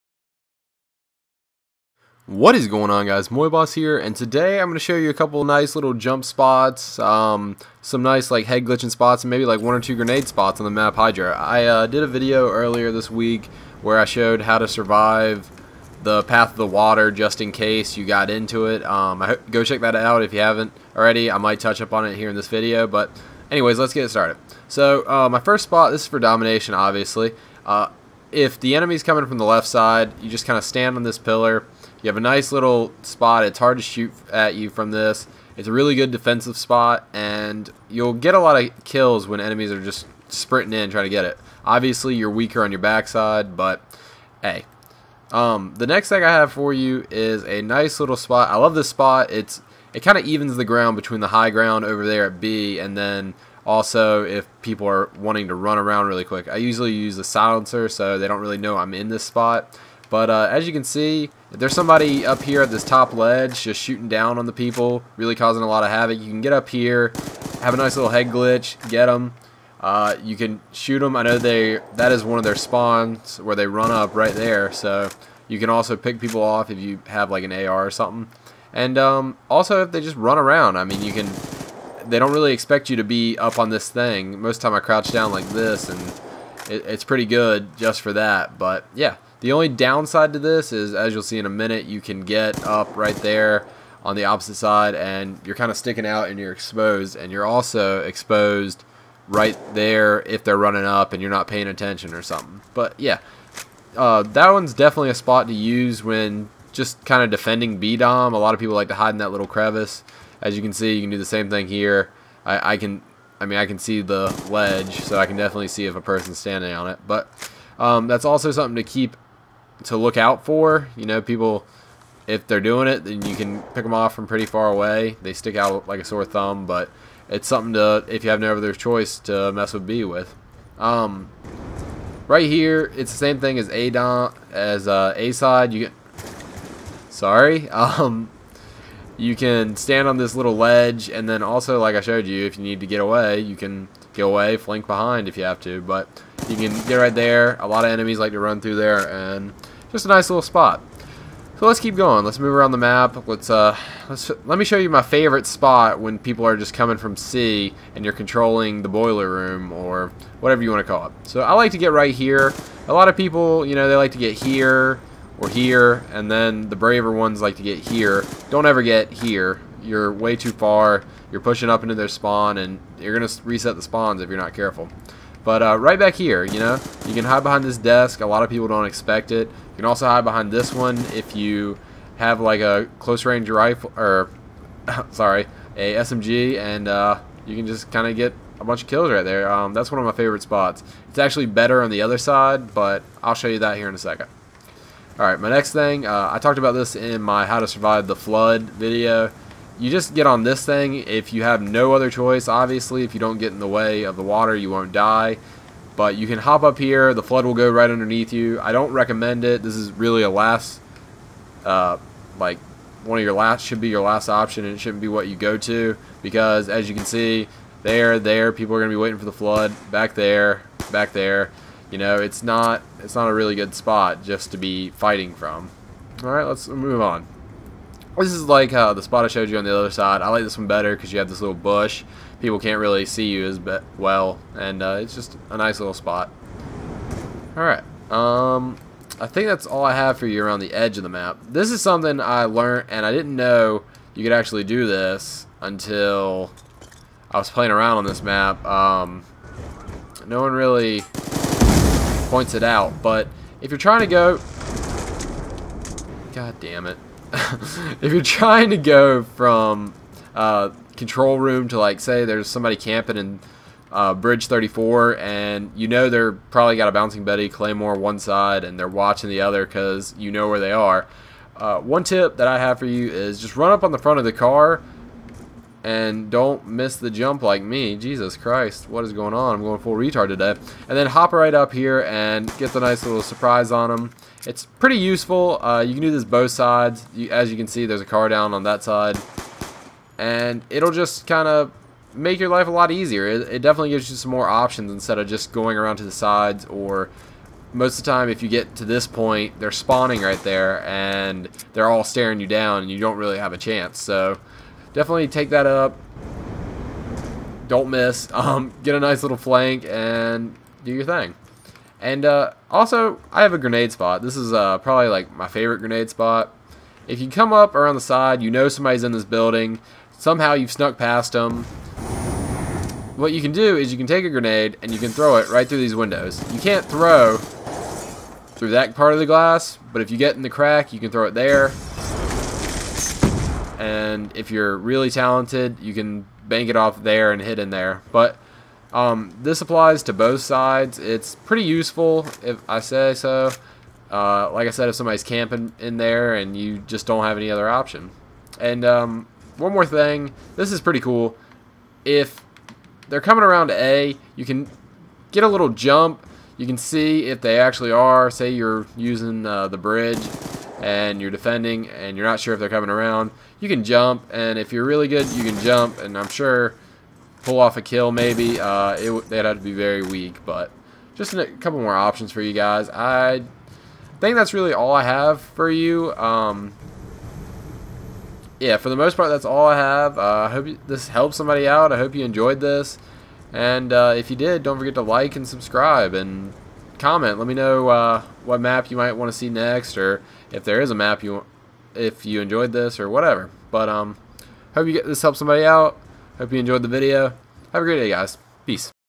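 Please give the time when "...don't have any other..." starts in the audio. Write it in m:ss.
5:47.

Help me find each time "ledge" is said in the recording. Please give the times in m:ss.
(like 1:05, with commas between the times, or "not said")
1:03, 1:54, 2:20.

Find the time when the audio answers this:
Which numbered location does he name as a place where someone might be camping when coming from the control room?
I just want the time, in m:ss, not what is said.
4:24.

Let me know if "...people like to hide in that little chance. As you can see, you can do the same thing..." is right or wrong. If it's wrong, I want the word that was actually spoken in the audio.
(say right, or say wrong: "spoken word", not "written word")
wrong: "crevice", not "chance".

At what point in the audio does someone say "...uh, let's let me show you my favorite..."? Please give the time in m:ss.
2:33.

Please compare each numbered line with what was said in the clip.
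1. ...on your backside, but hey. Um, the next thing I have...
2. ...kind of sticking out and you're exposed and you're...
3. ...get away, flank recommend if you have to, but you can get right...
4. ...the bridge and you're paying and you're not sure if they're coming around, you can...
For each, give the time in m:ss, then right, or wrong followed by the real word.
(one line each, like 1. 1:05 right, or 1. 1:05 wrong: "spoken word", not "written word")
1. 0:42 right
2. 1:35 right
3. 2:24 wrong: "behind", not "recommend"
4. 5:59 wrong: "defending", not "paying".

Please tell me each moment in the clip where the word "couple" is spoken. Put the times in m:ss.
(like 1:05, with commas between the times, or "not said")
0:05, 6:11.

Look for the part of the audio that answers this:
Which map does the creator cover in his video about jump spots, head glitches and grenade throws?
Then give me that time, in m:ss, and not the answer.
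0:10.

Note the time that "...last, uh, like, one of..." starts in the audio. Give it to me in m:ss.
3:30.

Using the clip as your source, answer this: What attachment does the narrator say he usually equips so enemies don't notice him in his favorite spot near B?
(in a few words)
silencer.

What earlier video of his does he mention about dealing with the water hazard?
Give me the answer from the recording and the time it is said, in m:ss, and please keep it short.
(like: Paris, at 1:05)
How to Survive the Flood, at 3:17.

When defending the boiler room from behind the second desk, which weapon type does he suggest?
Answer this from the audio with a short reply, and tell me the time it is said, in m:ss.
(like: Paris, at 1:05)
SMG, at 3:05.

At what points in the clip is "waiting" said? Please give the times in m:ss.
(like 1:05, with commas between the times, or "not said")
3:39.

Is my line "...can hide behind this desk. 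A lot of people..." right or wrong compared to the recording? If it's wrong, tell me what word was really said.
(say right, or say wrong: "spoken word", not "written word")
right.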